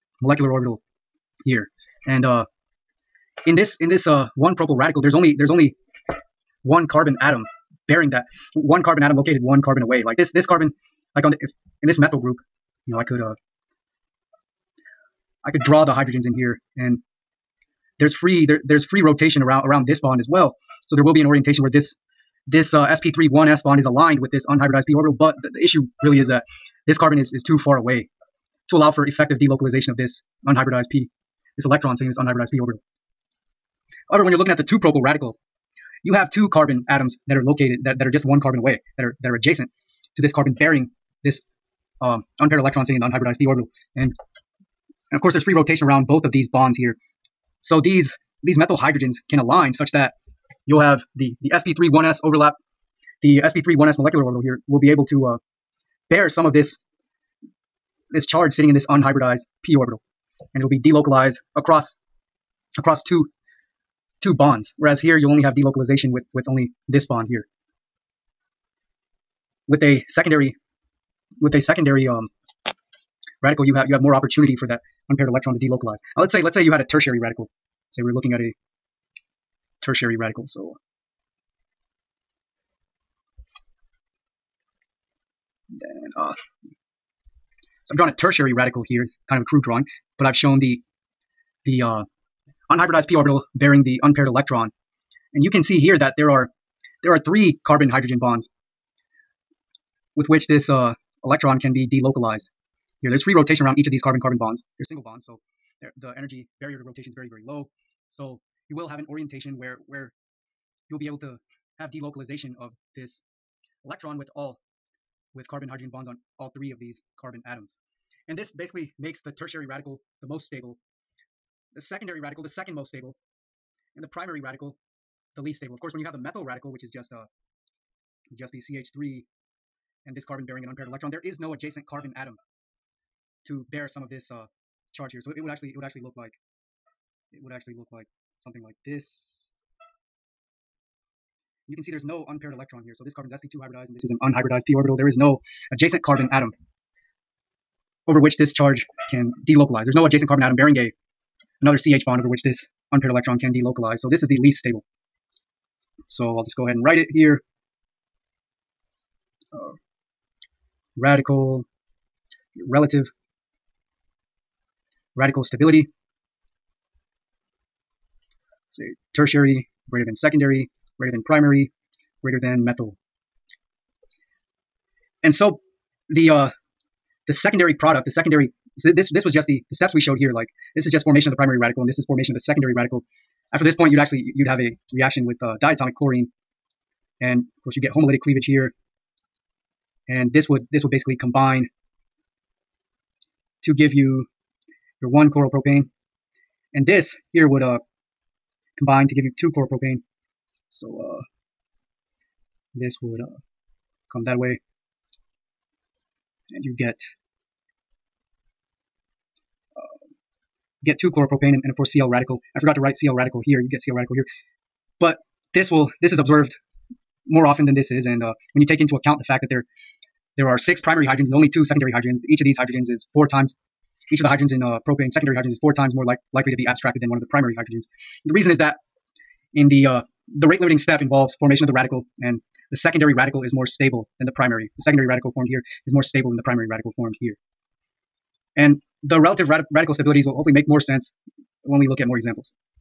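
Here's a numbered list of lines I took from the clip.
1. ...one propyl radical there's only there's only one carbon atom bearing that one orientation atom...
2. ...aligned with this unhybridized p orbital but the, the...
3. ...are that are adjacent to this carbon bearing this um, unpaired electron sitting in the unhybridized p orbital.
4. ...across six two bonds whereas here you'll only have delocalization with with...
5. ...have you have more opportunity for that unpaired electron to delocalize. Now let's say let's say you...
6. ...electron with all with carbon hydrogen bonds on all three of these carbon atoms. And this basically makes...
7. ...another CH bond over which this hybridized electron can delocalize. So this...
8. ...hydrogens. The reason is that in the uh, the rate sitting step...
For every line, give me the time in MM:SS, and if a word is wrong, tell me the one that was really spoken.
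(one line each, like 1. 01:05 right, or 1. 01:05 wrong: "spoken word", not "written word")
1. 00:04 wrong: "carbon", not "orientation"
2. 00:23 right
3. 00:39 right
4. 01:02 wrong: "two", not "six"
5. 01:13 right
6. 01:53 right
7. 02:31 wrong: "unpaired", not "hybridized"
8. 03:47 wrong: "limiting", not "sitting".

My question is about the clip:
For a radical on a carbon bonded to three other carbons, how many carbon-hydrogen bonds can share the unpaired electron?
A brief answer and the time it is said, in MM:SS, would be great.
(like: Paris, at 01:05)
3, at 01:37.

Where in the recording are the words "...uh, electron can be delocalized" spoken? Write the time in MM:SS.
01:40.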